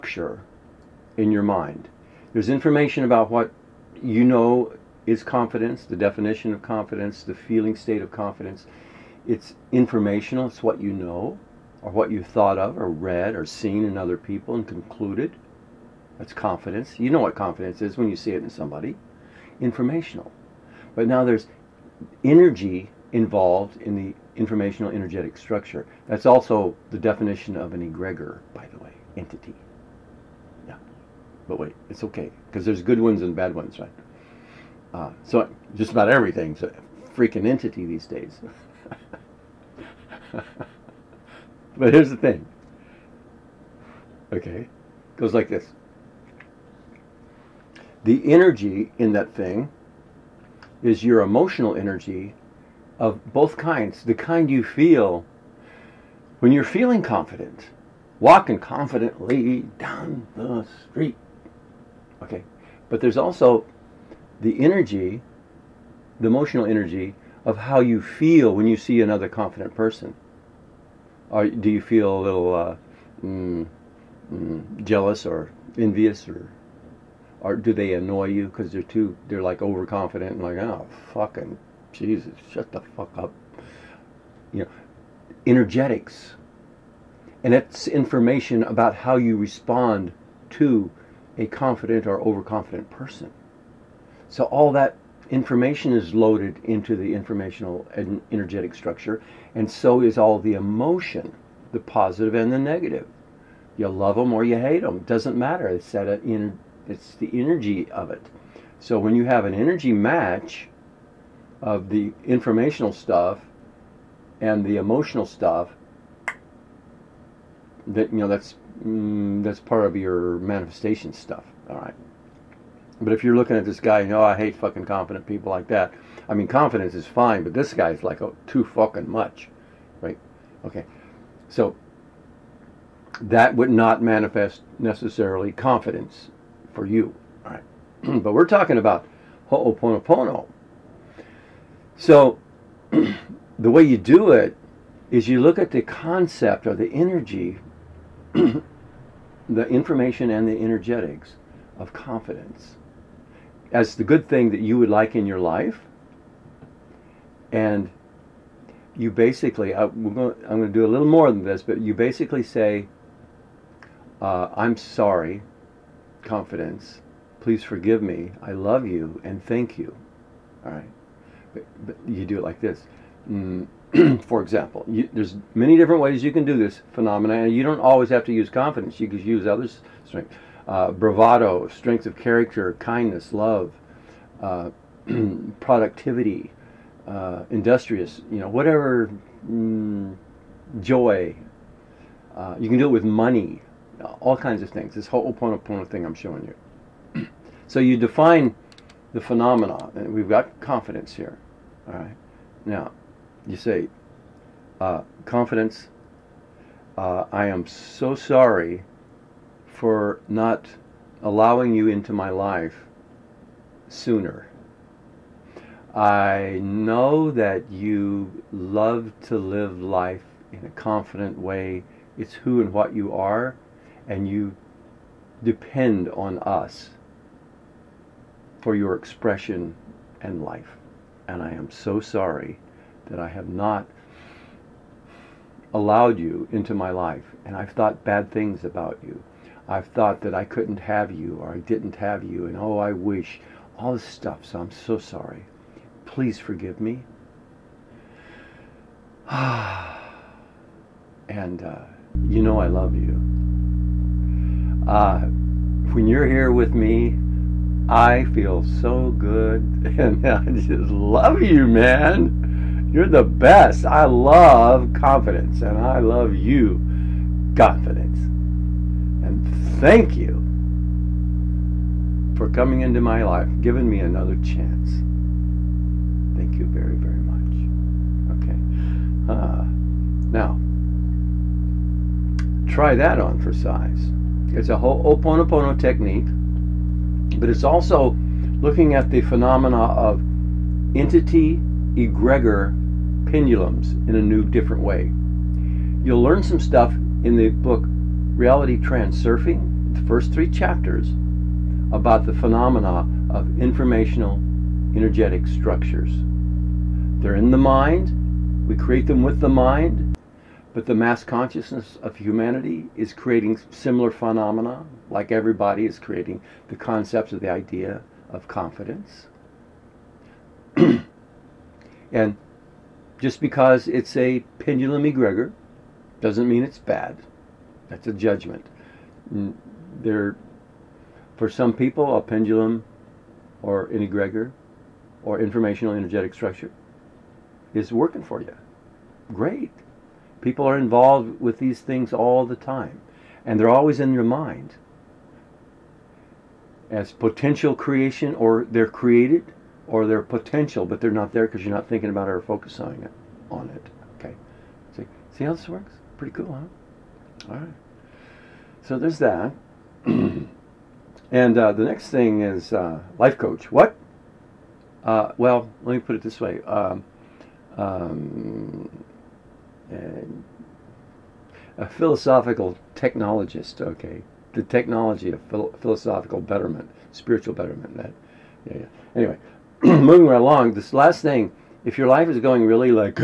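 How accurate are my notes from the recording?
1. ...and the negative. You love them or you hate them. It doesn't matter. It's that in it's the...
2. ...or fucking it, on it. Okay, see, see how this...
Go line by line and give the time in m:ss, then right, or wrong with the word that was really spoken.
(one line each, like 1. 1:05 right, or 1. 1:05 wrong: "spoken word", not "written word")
1. 1:42 right
2. 5:52 wrong: "focusing", not "fucking".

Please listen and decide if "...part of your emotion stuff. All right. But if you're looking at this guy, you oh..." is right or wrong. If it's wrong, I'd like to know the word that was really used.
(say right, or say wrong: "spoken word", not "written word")
wrong: "manifestation", not "emotion".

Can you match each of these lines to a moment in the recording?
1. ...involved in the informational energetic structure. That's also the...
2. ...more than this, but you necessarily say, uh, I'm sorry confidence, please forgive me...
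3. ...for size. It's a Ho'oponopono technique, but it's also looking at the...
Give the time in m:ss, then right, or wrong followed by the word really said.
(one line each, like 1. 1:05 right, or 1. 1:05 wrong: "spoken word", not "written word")
1. 0:23 right
2. 2:41 wrong: "basically", not "necessarily"
3. 4:43 right.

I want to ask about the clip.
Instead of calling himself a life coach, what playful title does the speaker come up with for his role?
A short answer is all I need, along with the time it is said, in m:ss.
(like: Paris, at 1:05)
philosophical technologist, at 6:11.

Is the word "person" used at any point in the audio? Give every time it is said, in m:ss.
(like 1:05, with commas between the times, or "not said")
1:09, 1:32.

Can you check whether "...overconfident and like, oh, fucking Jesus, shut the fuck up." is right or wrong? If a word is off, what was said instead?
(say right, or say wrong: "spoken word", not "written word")
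right.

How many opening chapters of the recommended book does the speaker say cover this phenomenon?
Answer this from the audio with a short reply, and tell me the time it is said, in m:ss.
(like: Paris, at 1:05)
3, at 5:00.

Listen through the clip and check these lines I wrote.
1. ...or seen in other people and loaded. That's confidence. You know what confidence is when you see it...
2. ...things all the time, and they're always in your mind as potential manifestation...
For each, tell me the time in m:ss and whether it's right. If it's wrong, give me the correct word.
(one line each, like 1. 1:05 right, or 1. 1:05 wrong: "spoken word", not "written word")
1. 0:13 wrong: "concluded", not "loaded"
2. 5:41 wrong: "creation", not "manifestation".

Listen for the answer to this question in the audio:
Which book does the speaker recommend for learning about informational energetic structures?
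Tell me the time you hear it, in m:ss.
4:58.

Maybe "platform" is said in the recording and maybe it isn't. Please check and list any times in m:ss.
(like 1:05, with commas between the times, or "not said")
not said.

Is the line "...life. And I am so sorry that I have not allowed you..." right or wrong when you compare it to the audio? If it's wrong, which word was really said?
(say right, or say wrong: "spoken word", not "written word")
right.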